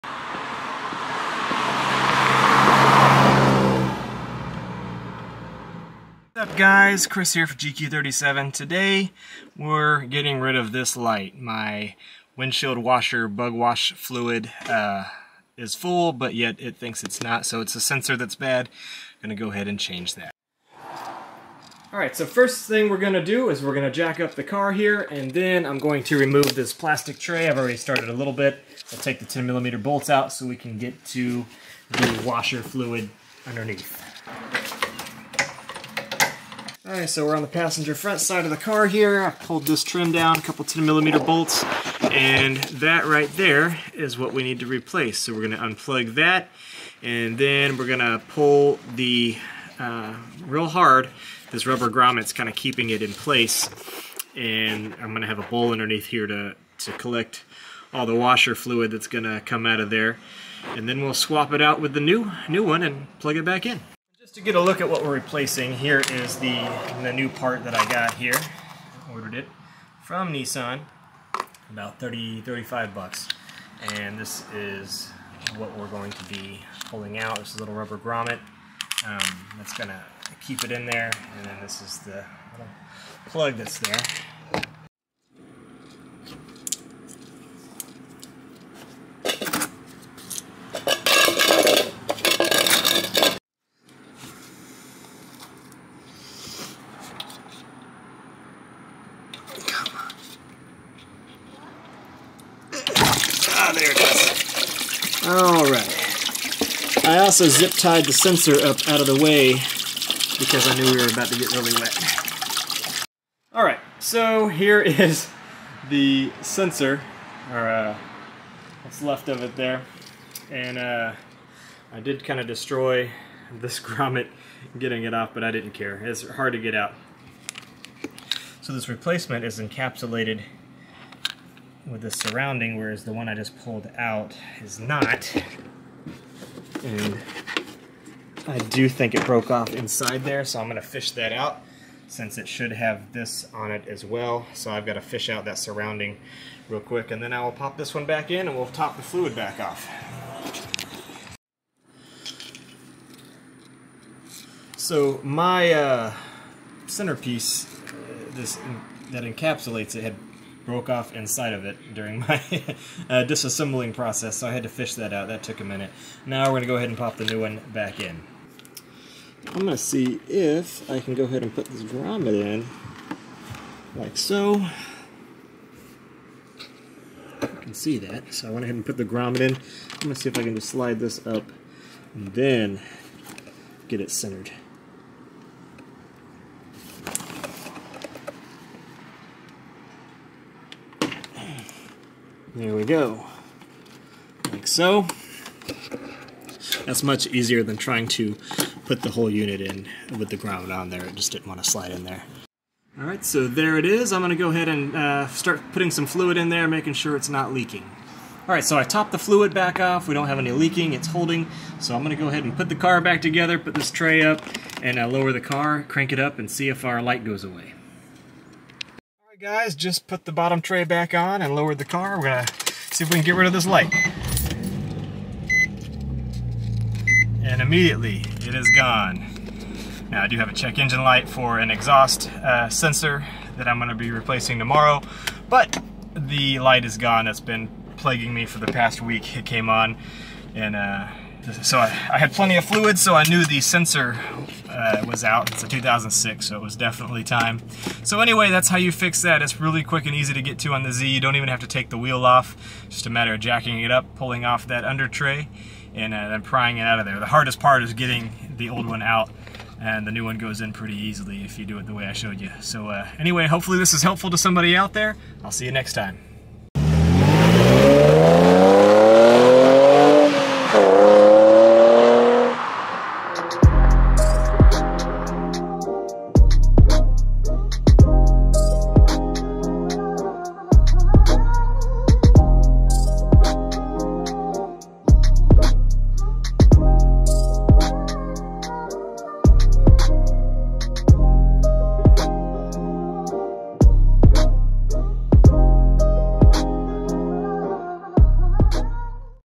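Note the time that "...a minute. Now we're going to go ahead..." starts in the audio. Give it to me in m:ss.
2:45.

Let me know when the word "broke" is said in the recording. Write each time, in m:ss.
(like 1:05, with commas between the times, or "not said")
2:19, 2:40.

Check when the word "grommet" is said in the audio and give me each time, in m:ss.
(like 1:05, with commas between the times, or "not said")
0:51, 1:17, 2:03, 2:51, 2:59.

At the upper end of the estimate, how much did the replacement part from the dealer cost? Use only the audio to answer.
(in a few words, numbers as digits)
$35.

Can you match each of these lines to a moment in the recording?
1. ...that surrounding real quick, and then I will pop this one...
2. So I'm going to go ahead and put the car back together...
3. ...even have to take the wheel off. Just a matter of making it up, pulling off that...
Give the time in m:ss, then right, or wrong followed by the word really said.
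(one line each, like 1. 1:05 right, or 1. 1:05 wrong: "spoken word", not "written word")
1. 2:25 right
2. 3:31 right
3. 4:11 wrong: "jacking", not "making".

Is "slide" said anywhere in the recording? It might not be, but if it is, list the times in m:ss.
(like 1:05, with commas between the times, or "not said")
3:00, 3:21.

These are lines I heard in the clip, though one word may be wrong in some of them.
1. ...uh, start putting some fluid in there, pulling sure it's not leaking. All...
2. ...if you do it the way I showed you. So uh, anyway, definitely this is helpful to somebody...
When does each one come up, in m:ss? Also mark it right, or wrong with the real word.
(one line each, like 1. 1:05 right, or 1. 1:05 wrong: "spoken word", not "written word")
1. 3:24 wrong: "making", not "pulling"
2. 4:21 wrong: "hopefully", not "definitely".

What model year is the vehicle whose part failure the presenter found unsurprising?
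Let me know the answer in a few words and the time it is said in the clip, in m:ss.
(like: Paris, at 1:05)
2006, at 4:05.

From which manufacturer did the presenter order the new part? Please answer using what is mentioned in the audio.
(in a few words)
Nissan.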